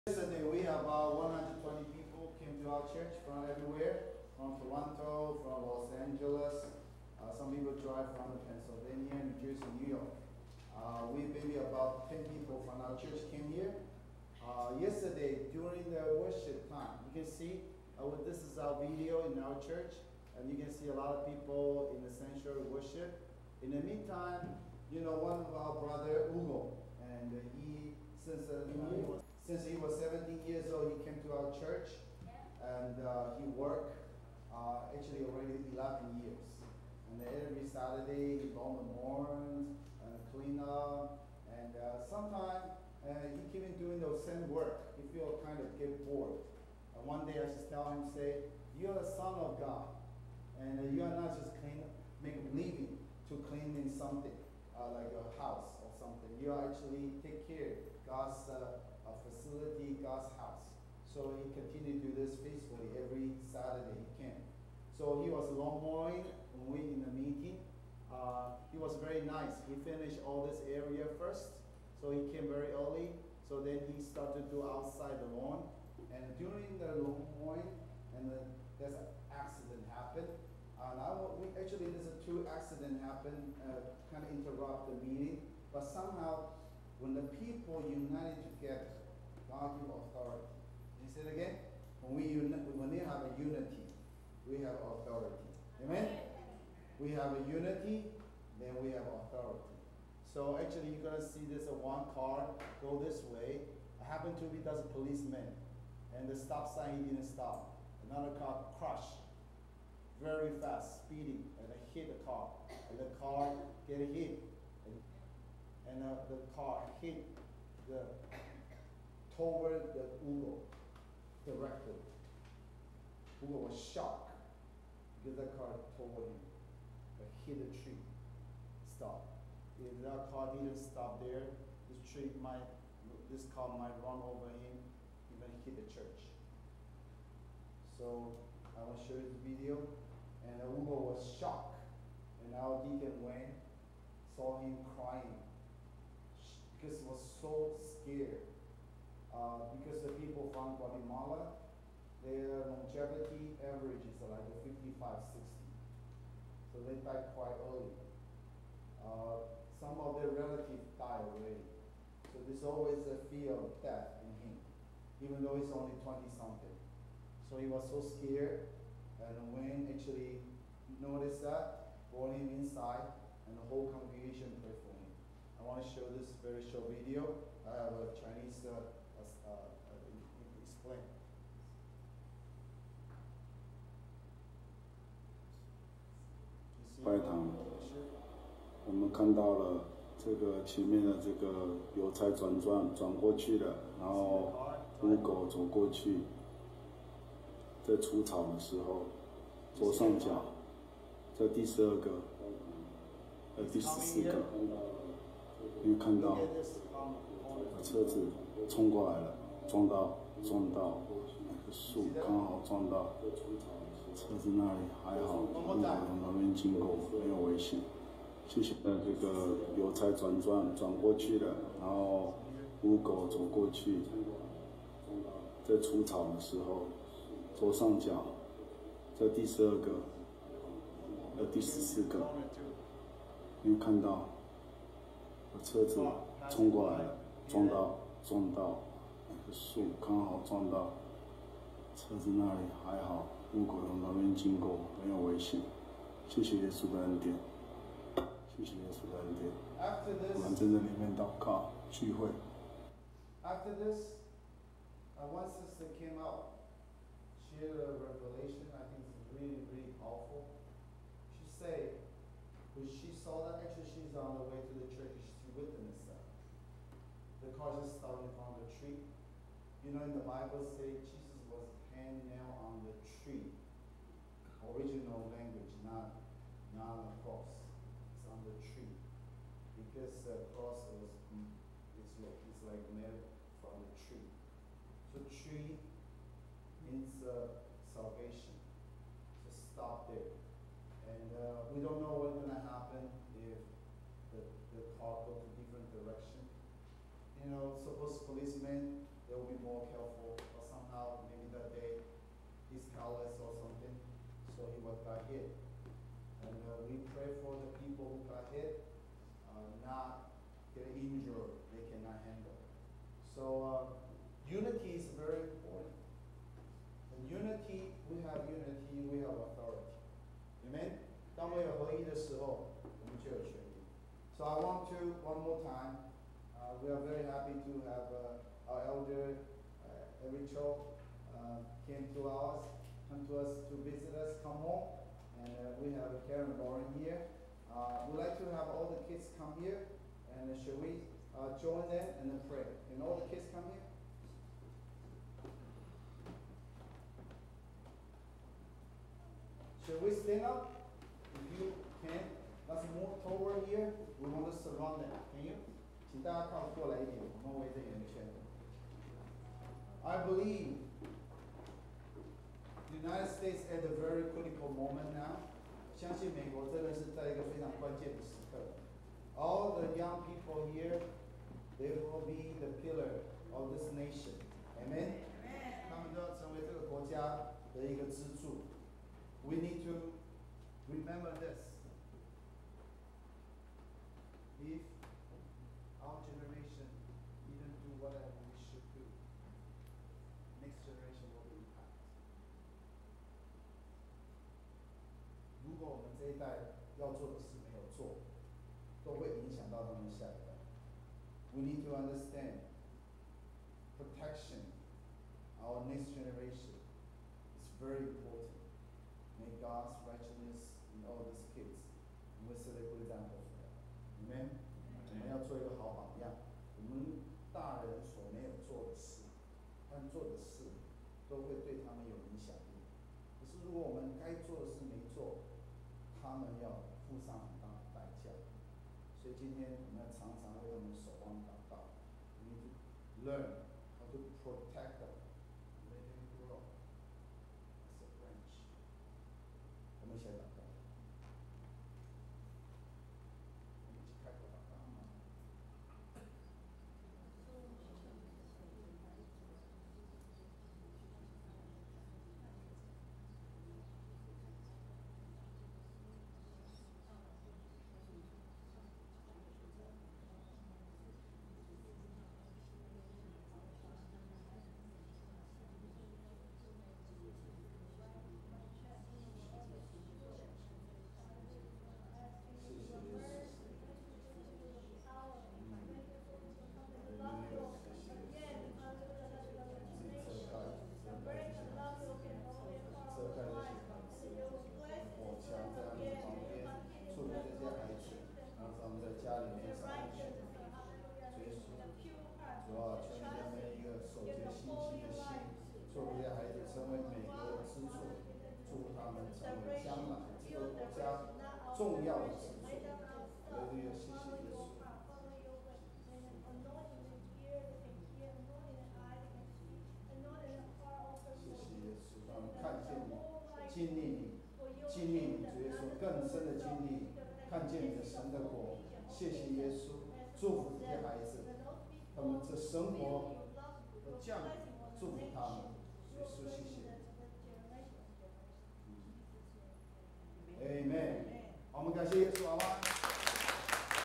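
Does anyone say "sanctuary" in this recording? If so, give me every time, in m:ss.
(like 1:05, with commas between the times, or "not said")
0:22.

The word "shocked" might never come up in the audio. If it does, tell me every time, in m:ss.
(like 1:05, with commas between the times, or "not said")
2:03, 2:21.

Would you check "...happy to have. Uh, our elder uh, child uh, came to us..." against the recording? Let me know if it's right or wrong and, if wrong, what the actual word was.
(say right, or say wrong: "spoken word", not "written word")
right.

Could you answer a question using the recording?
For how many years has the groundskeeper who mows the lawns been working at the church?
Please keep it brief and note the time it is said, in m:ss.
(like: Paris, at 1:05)
11 years, at 0:35.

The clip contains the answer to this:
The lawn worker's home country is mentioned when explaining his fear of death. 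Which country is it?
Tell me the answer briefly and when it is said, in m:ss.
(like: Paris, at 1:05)
Guatemala, at 2:30.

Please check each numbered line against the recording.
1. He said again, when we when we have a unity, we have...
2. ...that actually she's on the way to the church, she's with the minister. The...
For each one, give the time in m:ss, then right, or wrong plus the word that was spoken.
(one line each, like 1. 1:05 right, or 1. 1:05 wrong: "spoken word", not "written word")
1. 1:31 right
2. 4:23 right.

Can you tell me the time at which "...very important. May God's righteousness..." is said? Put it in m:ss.
6:47.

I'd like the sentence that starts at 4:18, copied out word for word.
I think it's really, really powerful.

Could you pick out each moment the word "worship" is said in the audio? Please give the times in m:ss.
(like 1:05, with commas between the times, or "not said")
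0:16, 0:22.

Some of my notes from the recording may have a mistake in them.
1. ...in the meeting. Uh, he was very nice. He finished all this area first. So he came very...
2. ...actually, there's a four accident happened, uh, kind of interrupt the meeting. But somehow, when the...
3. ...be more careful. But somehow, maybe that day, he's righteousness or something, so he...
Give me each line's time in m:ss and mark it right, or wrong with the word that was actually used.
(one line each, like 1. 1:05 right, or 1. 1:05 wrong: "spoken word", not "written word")
1. 1:06 right
2. 1:21 wrong: "two", not "four"
3. 4:59 wrong: "careless", not "righteousness".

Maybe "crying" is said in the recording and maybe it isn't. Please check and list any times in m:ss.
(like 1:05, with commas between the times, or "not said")
2:24.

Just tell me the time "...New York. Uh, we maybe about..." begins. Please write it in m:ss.
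0:09.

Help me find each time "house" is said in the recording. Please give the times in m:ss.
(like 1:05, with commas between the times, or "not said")
0:55, 1:00.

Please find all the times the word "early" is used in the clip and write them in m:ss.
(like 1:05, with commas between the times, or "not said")
1:12, 2:37.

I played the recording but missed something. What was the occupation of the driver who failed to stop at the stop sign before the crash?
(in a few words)
policeman.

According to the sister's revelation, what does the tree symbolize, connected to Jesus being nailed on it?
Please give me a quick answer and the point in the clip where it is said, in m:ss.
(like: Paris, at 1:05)
salvation, at 4:47.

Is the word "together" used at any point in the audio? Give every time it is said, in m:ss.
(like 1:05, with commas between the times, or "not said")
1:28.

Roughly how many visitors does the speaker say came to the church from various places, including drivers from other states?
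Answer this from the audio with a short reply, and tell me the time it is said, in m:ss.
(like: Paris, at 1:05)
120, at 0:01.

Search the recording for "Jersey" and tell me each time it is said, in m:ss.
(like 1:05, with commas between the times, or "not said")
0:09.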